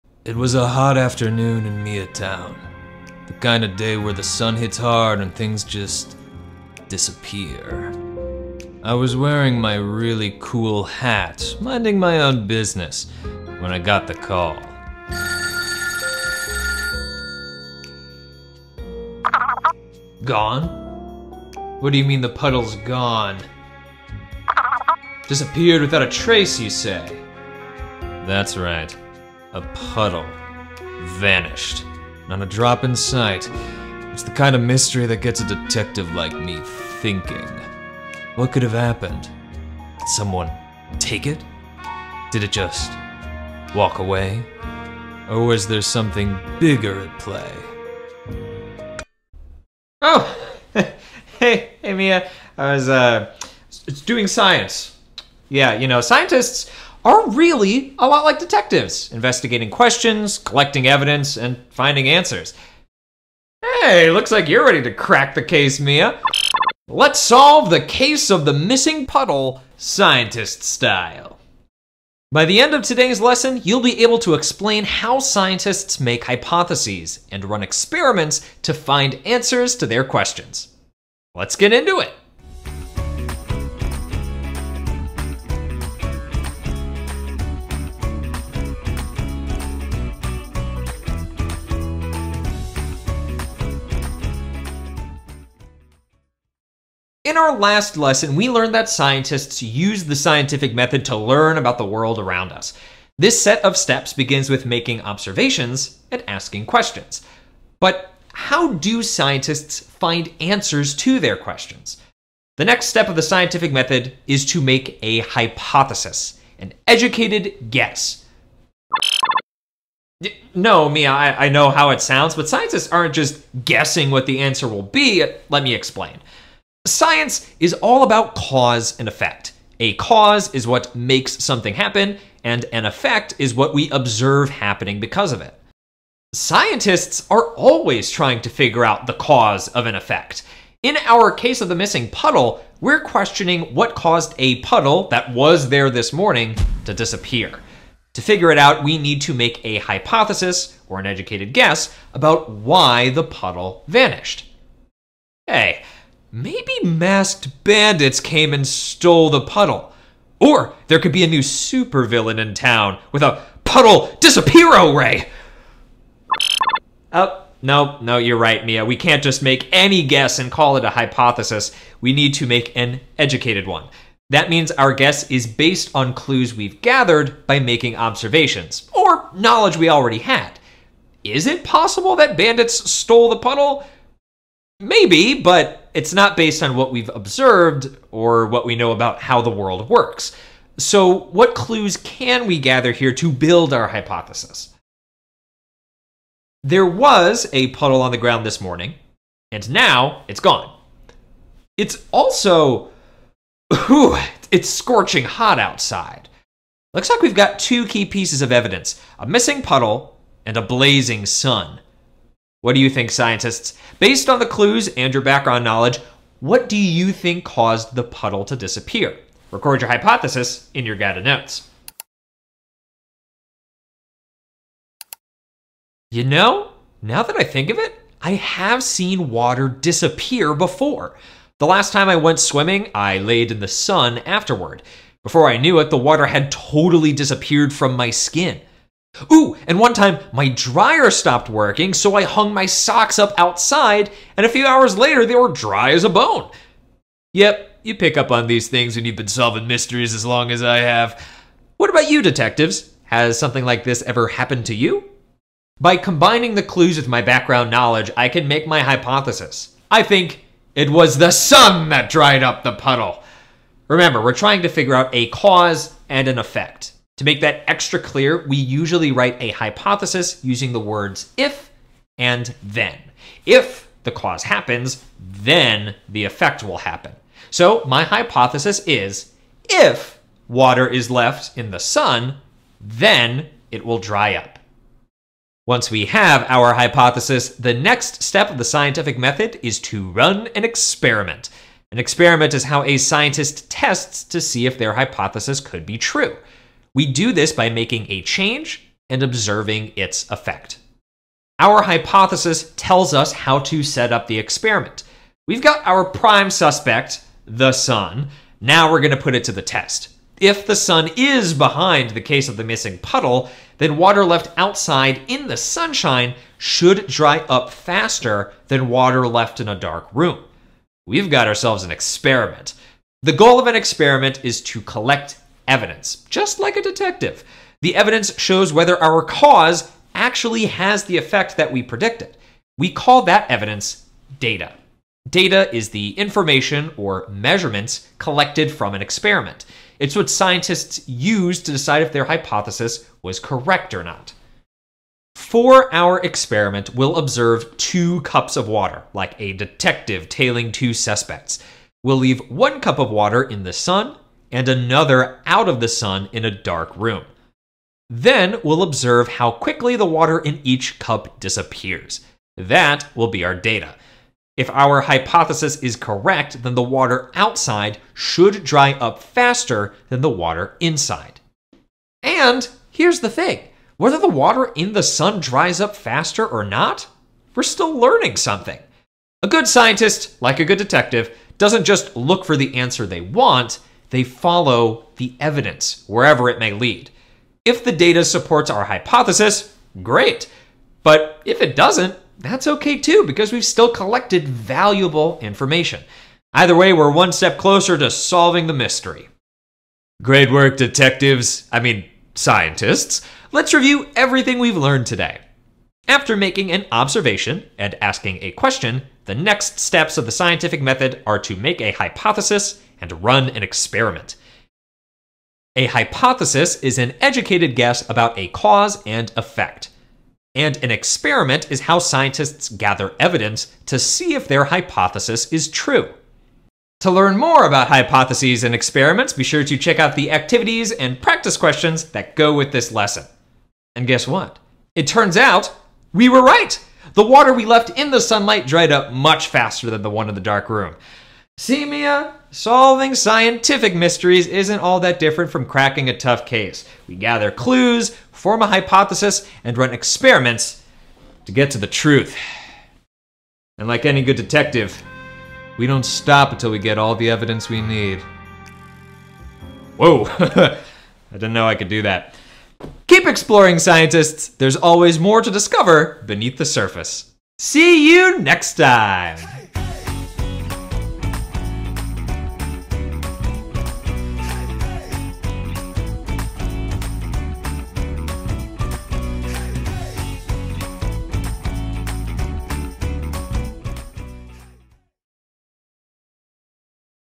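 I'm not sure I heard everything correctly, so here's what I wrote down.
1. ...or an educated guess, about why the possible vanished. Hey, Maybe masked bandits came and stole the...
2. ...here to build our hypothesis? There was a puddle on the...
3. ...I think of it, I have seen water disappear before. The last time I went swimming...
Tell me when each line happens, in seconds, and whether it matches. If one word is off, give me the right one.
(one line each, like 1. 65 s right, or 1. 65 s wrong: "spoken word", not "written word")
1. 150 s wrong: "puddle", not "possible"
2. 192 s right
3. 227 s right.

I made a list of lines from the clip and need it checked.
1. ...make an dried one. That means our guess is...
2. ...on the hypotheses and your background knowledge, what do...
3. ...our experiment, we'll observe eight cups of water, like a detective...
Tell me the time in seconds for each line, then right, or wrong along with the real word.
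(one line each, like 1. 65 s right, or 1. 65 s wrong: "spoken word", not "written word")
1. 172 s wrong: "educated", not "dried"
2. 214 s wrong: "clues", not "hypotheses"
3. 345 s wrong: "two", not "eight".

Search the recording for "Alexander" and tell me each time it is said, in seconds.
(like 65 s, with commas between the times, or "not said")
not said.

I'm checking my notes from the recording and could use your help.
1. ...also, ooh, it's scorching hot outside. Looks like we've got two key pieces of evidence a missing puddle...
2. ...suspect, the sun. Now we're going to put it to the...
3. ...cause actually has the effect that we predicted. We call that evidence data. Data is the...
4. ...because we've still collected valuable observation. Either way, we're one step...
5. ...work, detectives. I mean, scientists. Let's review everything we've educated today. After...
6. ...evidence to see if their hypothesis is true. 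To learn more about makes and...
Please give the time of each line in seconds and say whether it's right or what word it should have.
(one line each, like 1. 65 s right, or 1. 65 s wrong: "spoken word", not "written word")
1. 202 s right
2. 306 s right
3. 329 s right
4. 393 s wrong: "information", not "observation"
5. 400 s wrong: "learned", not "educated"
6. 423 s wrong: "hypotheses", not "makes".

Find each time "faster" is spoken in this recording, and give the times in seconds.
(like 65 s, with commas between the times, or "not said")
317 s, 369 s, 375 s, 439 s.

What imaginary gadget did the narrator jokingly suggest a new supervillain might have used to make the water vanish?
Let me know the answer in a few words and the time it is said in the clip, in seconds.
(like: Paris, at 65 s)
puddle disappear ray, at 163 s.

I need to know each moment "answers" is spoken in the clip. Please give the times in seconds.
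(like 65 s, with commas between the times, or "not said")
62 s, 79 s, 110 s, 124 s, 382 s.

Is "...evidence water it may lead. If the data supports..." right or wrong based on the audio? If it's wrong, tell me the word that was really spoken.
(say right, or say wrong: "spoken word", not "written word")
wrong: "wherever", not "water".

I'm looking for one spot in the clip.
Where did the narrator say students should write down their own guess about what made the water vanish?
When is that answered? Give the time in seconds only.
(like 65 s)
220 s.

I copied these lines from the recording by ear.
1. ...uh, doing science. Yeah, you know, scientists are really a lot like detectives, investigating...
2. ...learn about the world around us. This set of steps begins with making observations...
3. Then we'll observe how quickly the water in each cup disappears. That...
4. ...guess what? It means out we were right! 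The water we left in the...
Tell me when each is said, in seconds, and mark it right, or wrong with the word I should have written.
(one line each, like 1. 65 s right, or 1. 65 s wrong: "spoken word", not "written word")
1. 52 s right
2. 101 s right
3. 358 s right
4. 434 s wrong: "turns", not "means".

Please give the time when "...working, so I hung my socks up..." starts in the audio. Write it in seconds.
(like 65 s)
241 s.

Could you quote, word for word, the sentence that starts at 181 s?
Is it possible that bandits stole the puddle?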